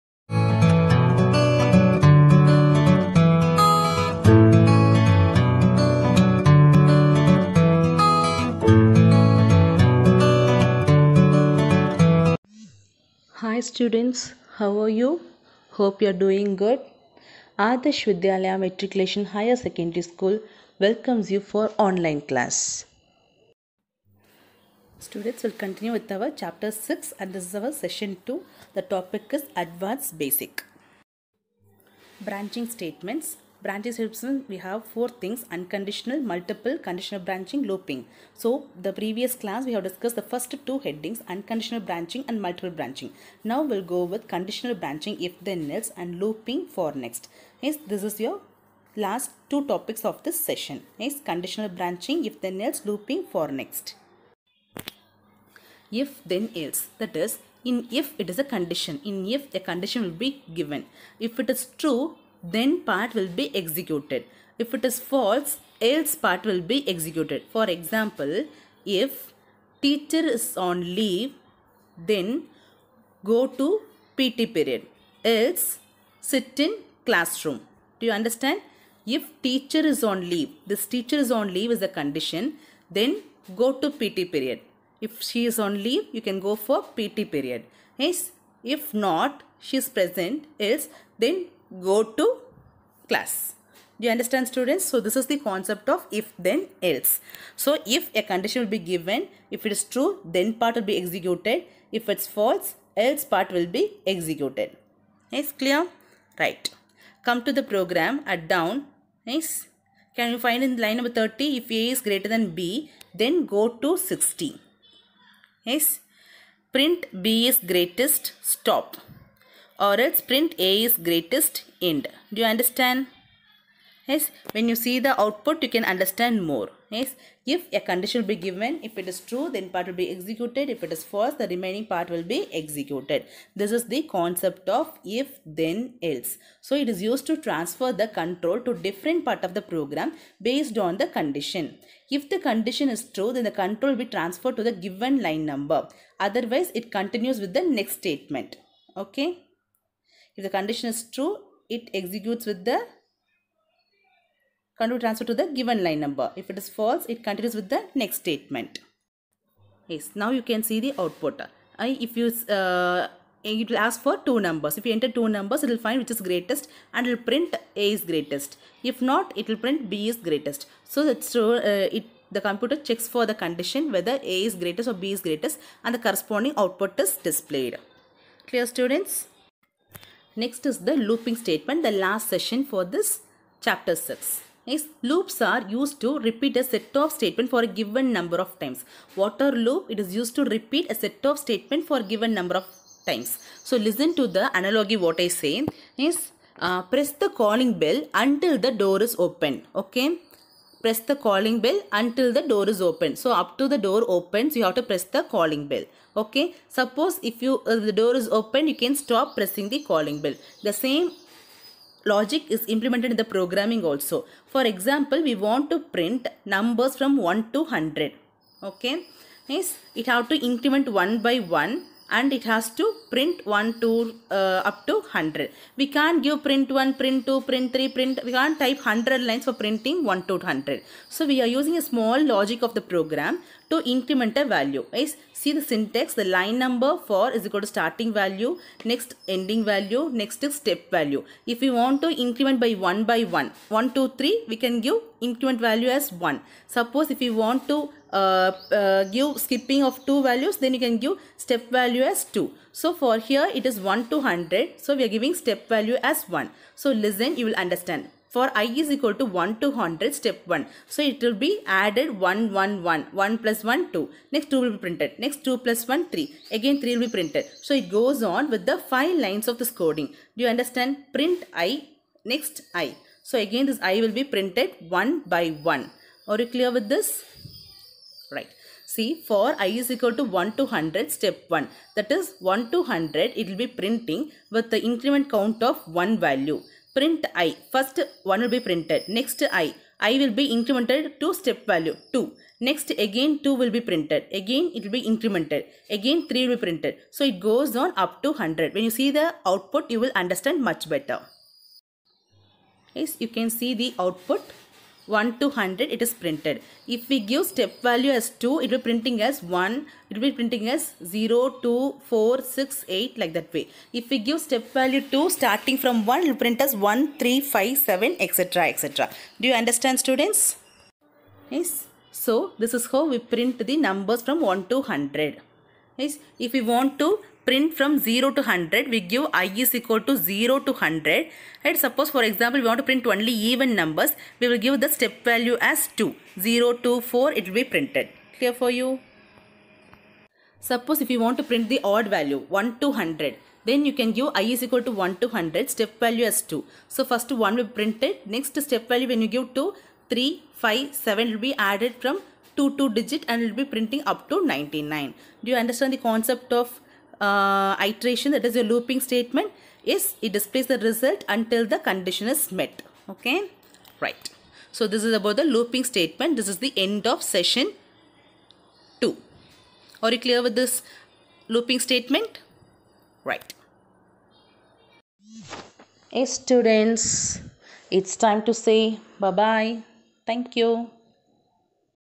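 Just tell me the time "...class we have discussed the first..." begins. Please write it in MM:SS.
00:39.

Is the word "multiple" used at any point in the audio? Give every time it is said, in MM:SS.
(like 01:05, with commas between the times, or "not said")
00:36, 00:42.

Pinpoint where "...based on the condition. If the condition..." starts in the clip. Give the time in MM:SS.
02:20.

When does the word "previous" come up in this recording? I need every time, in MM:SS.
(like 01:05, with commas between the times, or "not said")
00:38.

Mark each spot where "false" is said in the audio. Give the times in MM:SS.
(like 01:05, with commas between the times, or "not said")
01:04, 01:42, 02:11, 02:36.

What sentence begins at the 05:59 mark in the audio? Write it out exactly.
Yes, it displays the result until the condition is met.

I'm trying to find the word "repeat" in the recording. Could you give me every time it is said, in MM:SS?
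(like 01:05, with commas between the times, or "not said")
03:06, 03:10.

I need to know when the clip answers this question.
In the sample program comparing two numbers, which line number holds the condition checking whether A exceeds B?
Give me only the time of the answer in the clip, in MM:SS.
01:50.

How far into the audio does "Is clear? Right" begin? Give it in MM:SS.
01:45.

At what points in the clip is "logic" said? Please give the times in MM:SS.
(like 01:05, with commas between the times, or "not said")
03:32, 03:52.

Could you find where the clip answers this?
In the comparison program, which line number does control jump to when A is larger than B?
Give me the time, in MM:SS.
01:53.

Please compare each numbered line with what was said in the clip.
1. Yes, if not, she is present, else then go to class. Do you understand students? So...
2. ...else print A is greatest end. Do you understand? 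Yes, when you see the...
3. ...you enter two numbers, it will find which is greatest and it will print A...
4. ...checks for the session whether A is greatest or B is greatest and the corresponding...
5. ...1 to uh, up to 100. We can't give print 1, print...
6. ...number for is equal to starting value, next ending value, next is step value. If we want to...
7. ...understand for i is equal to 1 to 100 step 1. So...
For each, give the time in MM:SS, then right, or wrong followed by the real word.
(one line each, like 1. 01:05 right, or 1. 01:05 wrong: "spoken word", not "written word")
1. 01:27 right
2. 01:59 right
3. 02:44 right
4. 02:52 wrong: "condition", not "session"
5. 03:43 right
6. 03:56 right
7. 04:17 right.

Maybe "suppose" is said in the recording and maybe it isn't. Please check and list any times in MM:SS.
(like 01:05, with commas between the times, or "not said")
03:26, 04:06, 05:31, 05:40.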